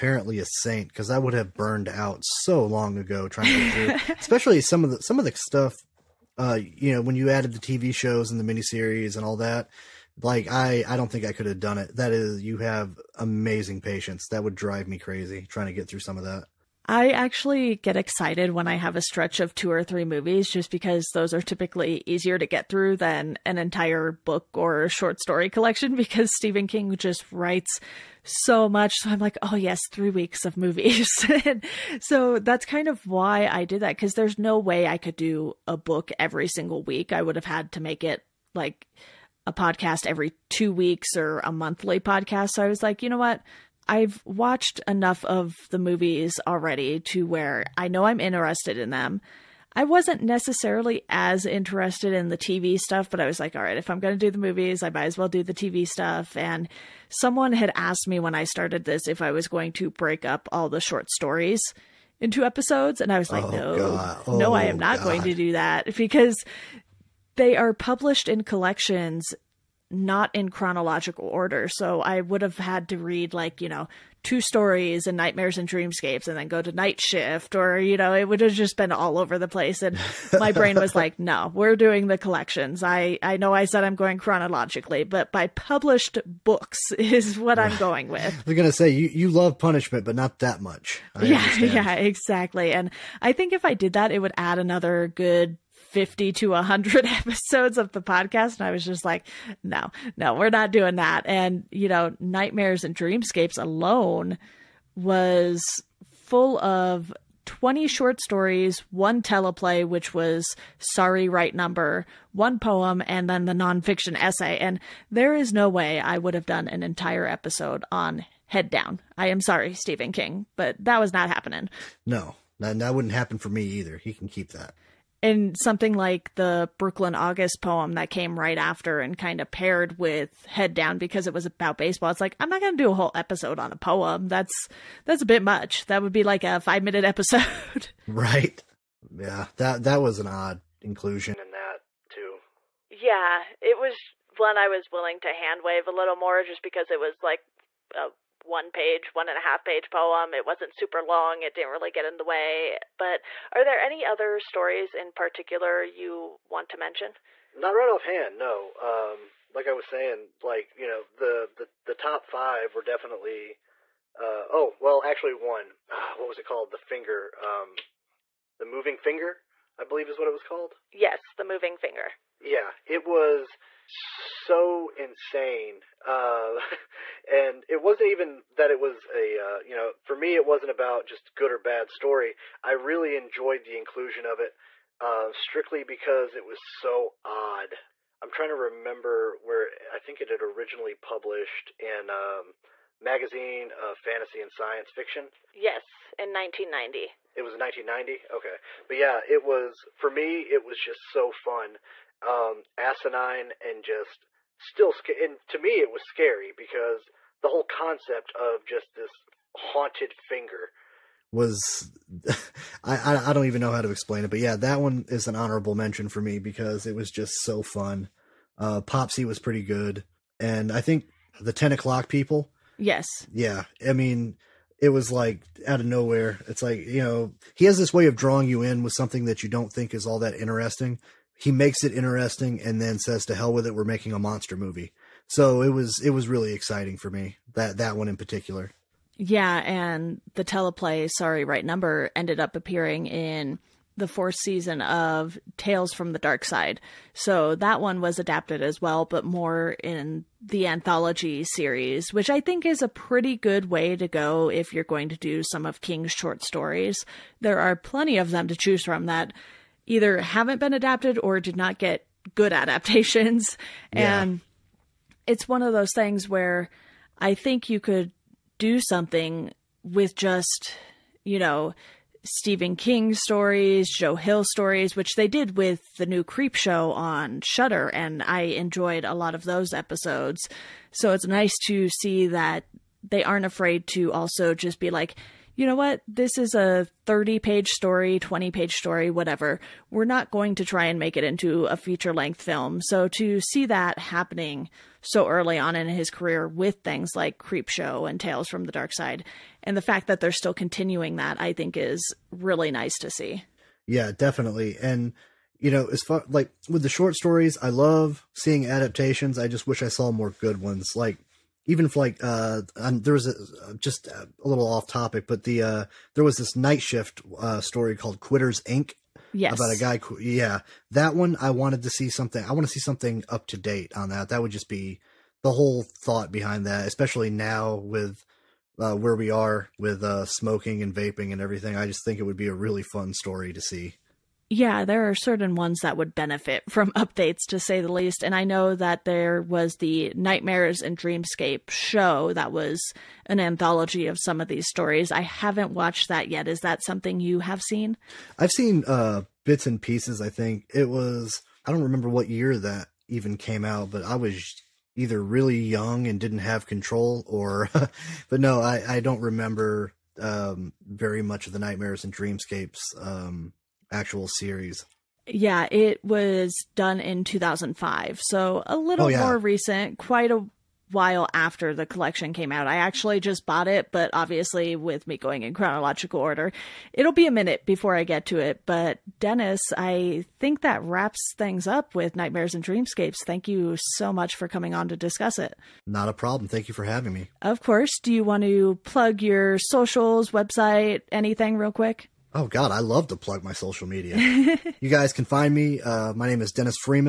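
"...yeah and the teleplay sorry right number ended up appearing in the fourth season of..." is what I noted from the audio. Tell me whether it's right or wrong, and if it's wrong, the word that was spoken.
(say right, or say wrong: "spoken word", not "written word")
right.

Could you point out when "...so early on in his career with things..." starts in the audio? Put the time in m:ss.
4:55.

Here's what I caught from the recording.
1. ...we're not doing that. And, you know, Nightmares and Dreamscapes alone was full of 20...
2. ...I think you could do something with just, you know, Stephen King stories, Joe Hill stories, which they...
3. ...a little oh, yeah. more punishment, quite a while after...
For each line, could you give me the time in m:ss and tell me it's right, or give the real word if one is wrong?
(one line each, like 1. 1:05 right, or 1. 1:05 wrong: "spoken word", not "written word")
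1. 1:40 right
2. 4:27 right
3. 6:08 wrong: "recent", not "punishment".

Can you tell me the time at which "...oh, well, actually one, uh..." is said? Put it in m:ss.
2:44.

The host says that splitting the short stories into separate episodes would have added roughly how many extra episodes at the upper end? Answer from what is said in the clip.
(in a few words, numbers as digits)
100.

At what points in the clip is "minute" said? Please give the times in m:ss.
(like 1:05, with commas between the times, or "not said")
2:16, 6:17.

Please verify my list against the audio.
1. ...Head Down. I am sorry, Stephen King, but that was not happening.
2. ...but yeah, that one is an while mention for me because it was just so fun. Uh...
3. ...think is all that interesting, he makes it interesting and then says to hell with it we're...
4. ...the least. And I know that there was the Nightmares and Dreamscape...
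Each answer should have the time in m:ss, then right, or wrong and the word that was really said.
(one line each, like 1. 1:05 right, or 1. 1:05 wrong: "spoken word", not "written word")
1. 1:58 right
2. 3:34 wrong: "honorable", not "while"
3. 3:49 right
4. 5:37 right.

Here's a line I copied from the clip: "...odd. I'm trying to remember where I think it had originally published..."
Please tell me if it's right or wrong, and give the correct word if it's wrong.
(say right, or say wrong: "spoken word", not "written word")
right.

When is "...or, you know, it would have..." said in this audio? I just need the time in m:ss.
1:17.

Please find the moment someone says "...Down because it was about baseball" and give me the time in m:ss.
2:10.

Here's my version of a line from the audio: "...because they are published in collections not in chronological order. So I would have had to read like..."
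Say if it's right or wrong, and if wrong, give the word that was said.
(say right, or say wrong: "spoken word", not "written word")
right.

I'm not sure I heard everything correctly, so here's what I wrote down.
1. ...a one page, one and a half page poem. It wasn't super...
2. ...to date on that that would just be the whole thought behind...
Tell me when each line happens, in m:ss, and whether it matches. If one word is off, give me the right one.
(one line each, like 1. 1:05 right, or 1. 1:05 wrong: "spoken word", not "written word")
1. 2:27 right
2. 5:23 right.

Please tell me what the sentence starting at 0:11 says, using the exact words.
That is, you have amazing patience.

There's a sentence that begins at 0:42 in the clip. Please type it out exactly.
So I was like, you know what?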